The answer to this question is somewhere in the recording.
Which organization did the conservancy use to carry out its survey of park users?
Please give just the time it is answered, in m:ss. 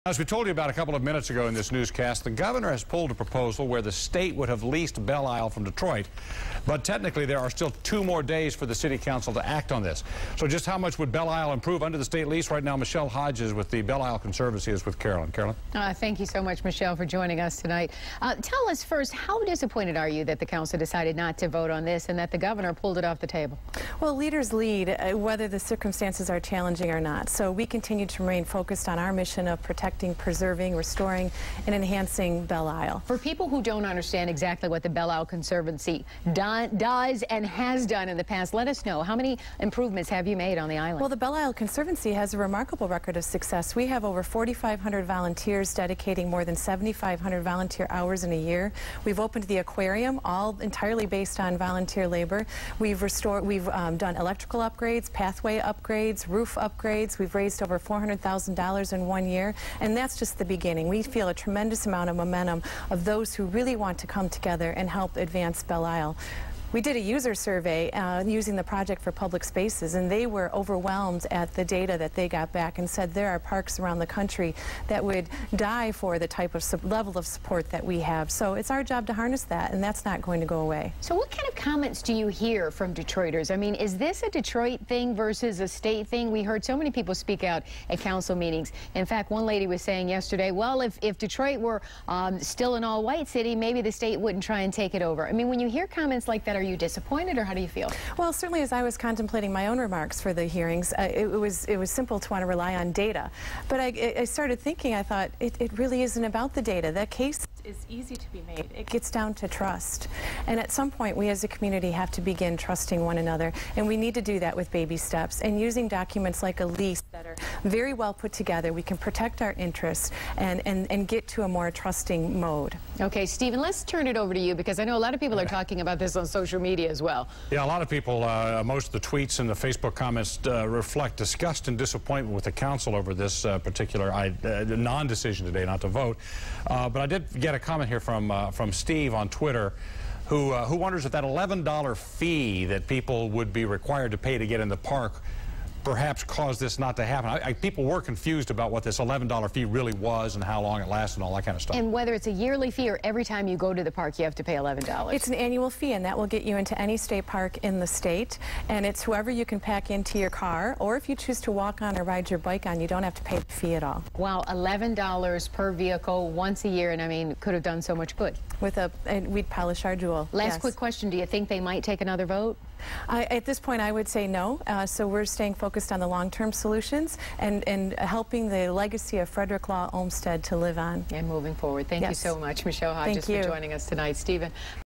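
1:08.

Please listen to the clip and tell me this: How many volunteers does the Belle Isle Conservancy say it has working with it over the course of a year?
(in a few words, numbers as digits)
4,500.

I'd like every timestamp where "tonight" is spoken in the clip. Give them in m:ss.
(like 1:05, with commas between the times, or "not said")
0:17, 3:03.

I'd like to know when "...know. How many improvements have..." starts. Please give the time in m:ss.
0:38.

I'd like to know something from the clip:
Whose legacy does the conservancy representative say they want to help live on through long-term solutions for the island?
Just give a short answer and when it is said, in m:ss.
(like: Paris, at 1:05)
Frederick Law Olmsted, at 2:59.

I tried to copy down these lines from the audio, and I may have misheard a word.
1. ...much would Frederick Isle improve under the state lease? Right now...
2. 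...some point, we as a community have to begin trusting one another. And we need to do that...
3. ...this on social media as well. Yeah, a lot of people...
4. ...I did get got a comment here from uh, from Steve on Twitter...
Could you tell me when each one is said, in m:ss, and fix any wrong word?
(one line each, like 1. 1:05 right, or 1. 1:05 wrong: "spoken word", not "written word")
1. 0:10 wrong: "Belle", not "Frederick"
2. 1:50 right
3. 2:05 right
4. 2:17 right.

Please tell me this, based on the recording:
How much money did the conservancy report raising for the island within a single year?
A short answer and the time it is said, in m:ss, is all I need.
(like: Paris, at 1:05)
$400,000, at 0:57.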